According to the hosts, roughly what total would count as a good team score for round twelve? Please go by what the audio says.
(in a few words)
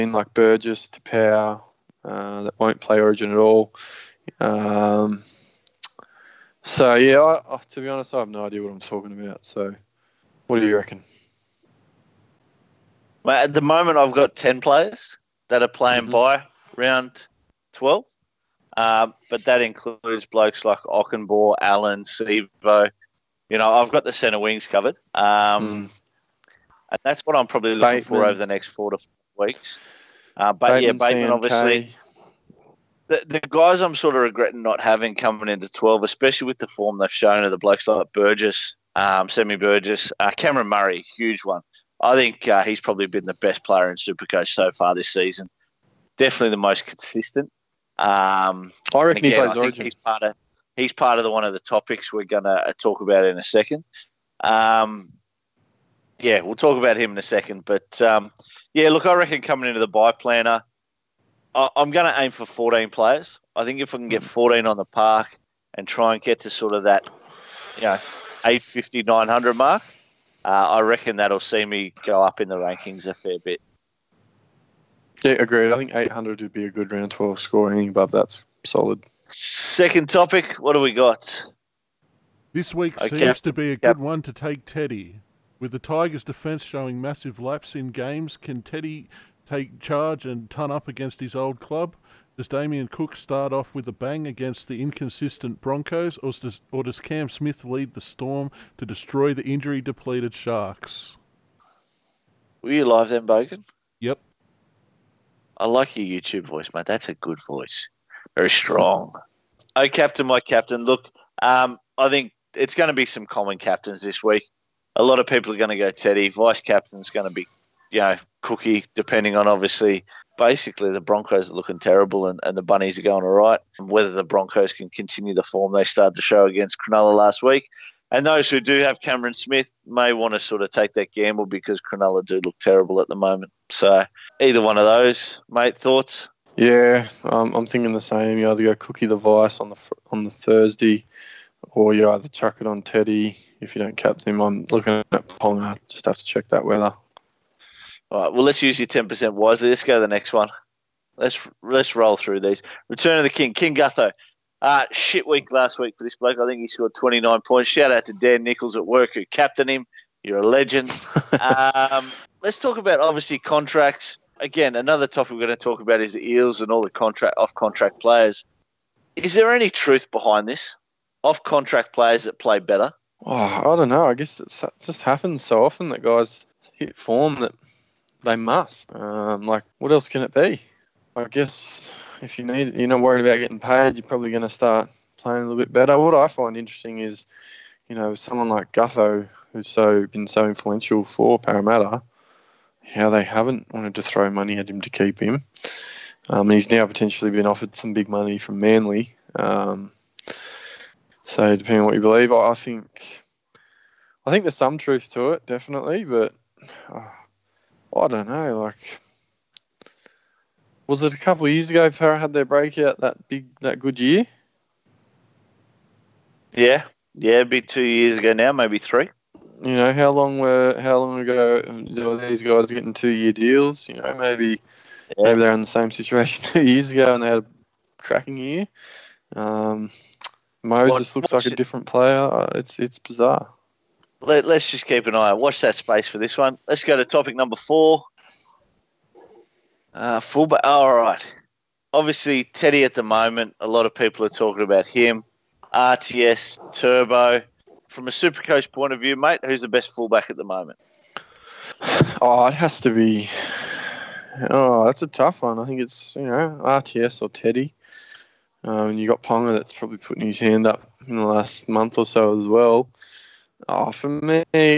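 800.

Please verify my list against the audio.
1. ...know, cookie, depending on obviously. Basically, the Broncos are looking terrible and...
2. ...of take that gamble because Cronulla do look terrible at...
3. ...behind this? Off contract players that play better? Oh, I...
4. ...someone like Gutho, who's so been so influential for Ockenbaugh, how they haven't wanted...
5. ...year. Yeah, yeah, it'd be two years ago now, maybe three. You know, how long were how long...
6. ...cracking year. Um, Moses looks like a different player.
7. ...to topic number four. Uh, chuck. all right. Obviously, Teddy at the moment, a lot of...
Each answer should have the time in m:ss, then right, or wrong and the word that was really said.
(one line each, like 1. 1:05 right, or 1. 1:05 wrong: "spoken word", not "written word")
1. 1:58 right
2. 2:10 right
3. 2:50 right
4. 3:08 wrong: "Parramatta", not "Ockenbaugh"
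5. 3:33 right
6. 3:47 right
7. 3:56 wrong: "fullback", not "chuck".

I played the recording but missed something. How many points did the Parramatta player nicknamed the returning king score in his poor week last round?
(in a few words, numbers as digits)
29.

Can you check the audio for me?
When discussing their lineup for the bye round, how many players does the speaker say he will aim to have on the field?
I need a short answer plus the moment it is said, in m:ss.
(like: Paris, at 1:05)
14, at 1:02.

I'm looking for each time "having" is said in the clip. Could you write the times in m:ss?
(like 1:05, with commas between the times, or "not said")
0:34.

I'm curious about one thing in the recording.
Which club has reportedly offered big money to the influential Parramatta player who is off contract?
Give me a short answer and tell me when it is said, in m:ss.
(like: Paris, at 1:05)
Manly, at 3:18.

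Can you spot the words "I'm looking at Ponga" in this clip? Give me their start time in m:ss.
2:24.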